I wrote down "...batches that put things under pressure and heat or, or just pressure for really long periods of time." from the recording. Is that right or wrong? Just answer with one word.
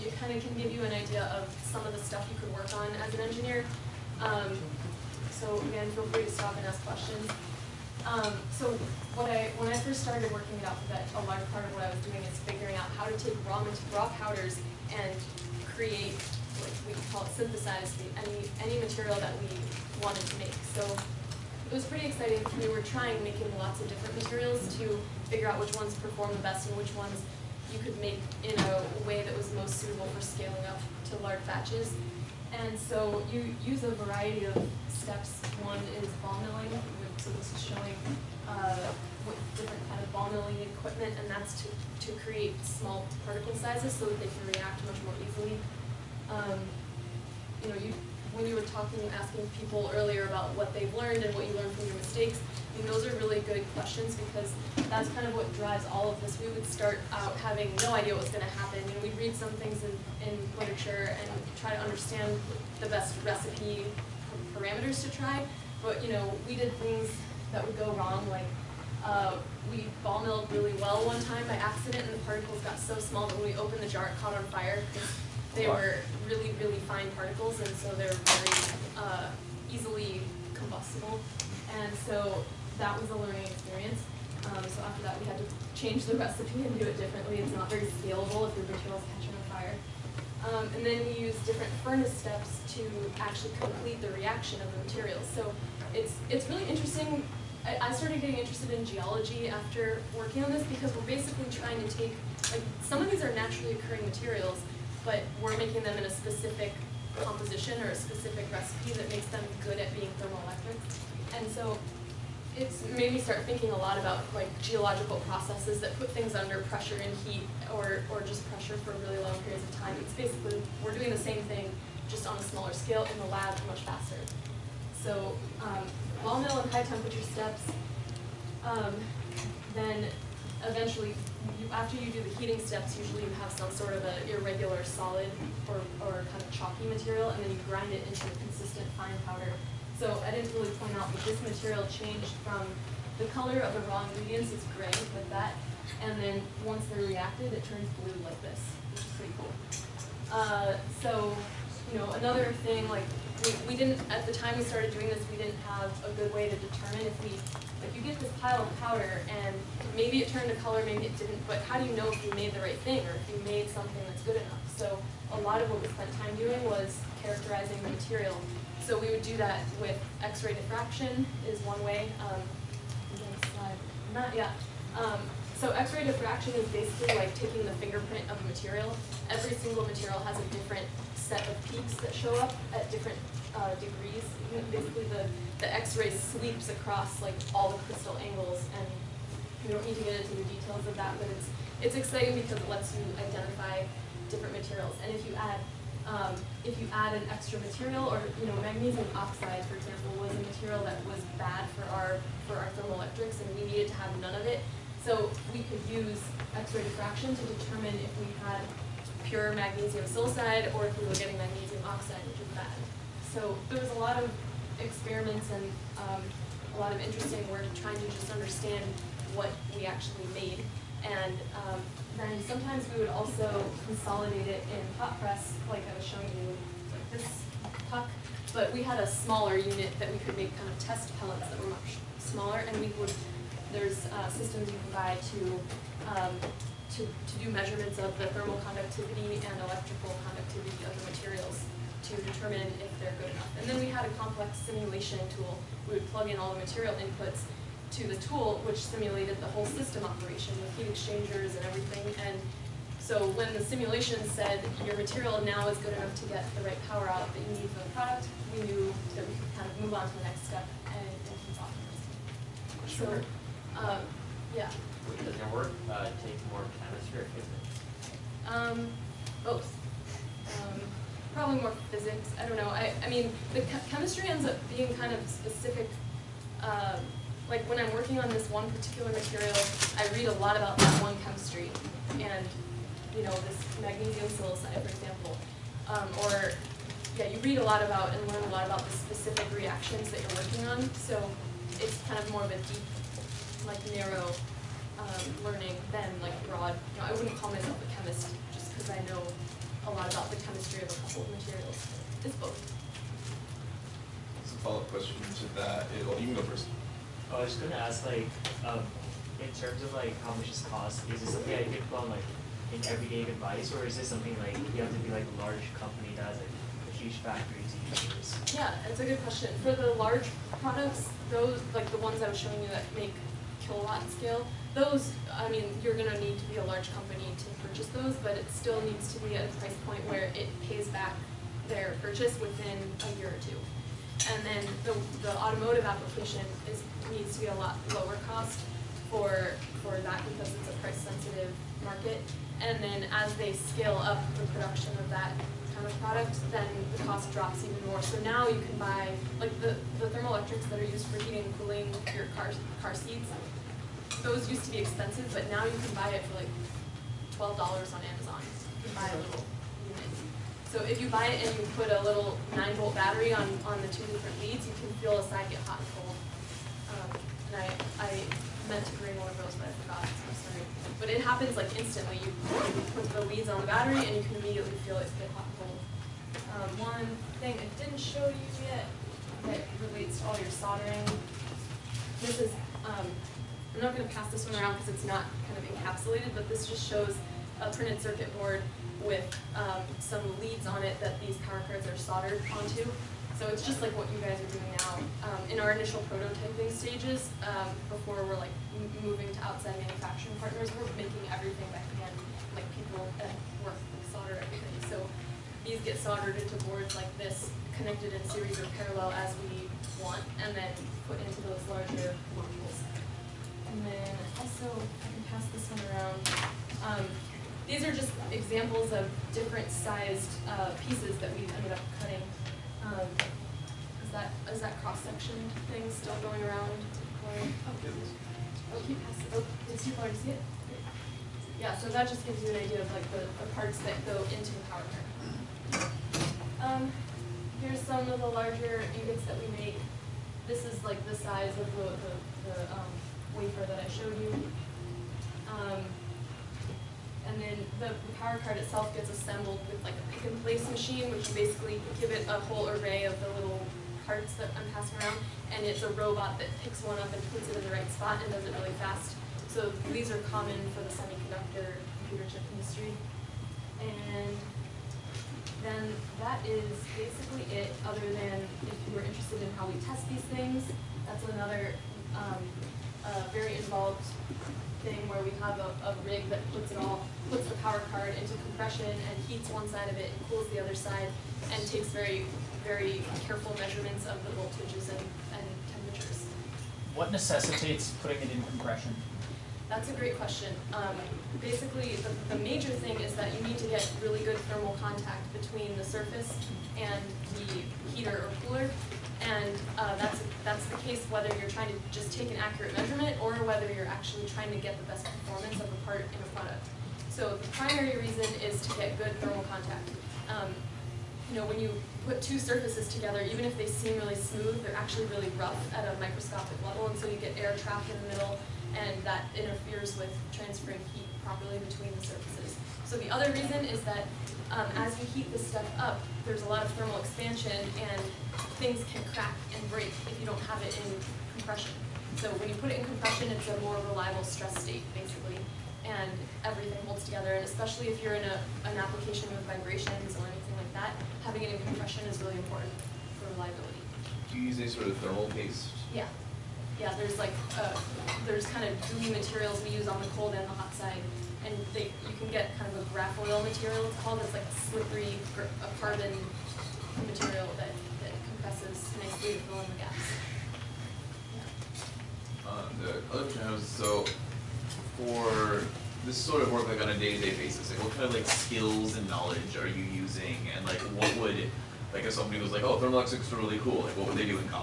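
wrong.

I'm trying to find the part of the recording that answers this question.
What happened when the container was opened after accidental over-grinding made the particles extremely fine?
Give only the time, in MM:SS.
01:14.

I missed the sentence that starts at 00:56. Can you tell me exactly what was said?
We would start out having no idea what's going to happen.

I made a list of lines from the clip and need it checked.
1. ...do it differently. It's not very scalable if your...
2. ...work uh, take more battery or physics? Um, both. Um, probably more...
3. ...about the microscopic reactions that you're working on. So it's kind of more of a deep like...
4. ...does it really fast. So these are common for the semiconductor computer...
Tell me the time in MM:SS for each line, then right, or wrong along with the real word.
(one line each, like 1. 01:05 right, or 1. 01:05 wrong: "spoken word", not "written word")
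1. 01:26 right
2. 04:25 wrong: "chemistry", not "battery"
3. 04:48 wrong: "specific", not "microscopic"
4. 07:38 right.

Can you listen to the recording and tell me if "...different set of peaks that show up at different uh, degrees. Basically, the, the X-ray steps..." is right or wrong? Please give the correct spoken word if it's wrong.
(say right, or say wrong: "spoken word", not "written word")
wrong: "sweeps", not "steps".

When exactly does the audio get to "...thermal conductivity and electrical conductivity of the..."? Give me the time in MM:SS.
03:58.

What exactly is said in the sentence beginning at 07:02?
Um, is that is that cross section thing still going around?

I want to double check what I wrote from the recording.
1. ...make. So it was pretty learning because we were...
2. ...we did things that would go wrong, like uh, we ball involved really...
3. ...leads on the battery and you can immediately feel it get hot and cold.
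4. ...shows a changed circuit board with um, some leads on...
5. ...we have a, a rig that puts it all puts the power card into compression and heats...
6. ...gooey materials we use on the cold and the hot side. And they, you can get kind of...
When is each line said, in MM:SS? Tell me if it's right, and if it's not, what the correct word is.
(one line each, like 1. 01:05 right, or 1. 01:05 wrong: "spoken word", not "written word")
1. 00:20 wrong: "exciting", not "learning"
2. 01:06 wrong: "milled", not "involved"
3. 06:13 right
4. 06:26 wrong: "printed", not "changed"
5. 07:55 right
6. 09:08 right.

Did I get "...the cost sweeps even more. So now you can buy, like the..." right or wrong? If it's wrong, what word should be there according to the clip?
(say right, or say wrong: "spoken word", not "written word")
wrong: "drops", not "sweeps".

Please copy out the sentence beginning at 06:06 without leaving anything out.
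Um, and I, I meant to bring one of those, but I forgot.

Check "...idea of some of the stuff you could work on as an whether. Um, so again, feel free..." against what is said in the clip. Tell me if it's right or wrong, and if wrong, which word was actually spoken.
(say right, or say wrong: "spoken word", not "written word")
wrong: "engineer", not "whether".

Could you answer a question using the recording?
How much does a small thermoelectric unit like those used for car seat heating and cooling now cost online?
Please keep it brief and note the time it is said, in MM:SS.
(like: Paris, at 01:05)
$12, at 05:57.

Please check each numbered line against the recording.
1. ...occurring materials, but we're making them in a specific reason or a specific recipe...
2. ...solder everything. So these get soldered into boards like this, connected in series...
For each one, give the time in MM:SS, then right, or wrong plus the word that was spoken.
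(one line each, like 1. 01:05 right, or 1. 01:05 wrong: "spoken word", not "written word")
1. 01:43 wrong: "composition", not "reason"
2. 06:44 right.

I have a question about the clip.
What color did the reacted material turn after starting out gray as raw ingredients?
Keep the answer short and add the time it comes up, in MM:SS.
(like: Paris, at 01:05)
Blue, at 02:28.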